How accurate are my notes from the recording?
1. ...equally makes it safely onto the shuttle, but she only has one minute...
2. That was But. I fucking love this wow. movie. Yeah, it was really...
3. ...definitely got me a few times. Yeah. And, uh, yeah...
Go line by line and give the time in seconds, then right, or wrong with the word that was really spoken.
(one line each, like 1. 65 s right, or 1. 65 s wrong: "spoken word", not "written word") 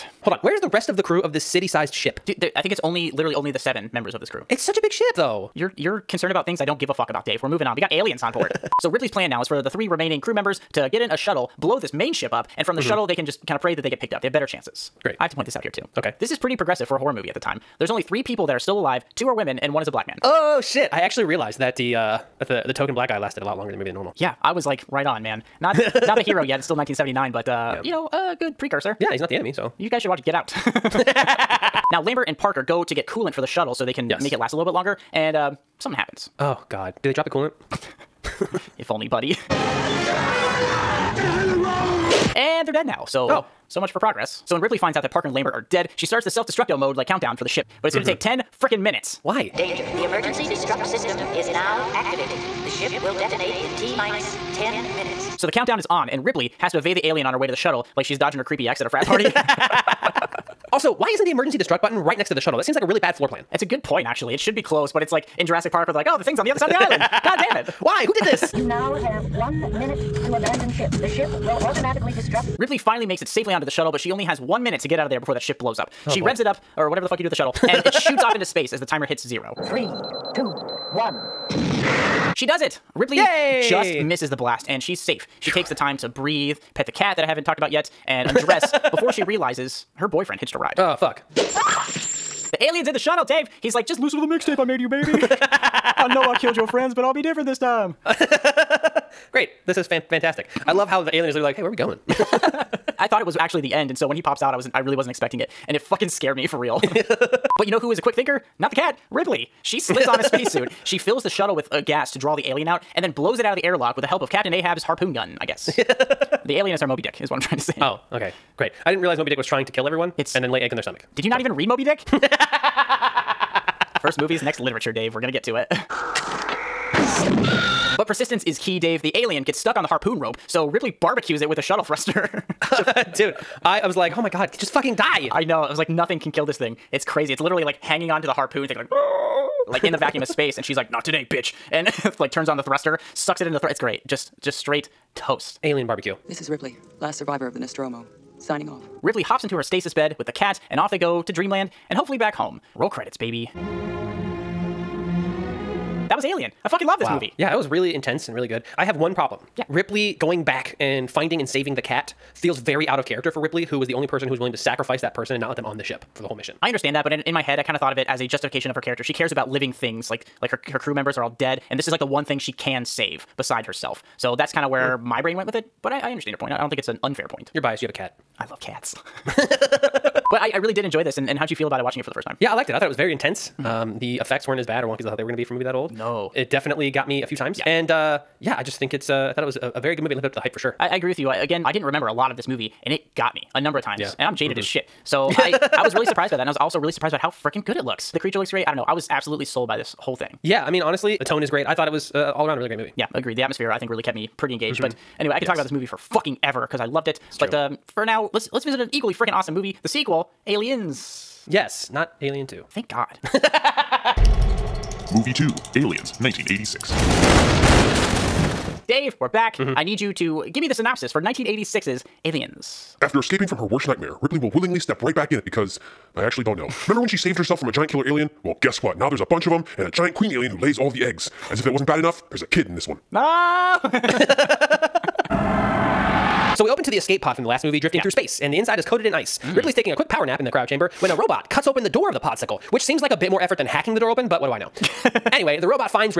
1. 72 s wrong: "finally", not "equally"
2. 156 s wrong: "Alien", not "But"
3. 186 s right.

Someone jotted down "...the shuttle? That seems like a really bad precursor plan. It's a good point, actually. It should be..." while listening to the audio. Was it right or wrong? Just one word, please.
wrong.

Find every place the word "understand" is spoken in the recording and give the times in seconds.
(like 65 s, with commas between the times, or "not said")
166 s, 176 s.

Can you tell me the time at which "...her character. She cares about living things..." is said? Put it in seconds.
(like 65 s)
168 s.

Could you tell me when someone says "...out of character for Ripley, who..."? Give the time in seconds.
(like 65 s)
162 s.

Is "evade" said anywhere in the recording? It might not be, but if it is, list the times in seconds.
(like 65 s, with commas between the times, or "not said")
56 s.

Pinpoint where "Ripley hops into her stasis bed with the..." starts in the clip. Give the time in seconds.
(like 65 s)
149 s.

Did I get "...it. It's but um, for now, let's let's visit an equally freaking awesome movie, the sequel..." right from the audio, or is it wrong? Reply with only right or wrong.
right.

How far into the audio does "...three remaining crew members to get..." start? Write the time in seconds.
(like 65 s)
9 s.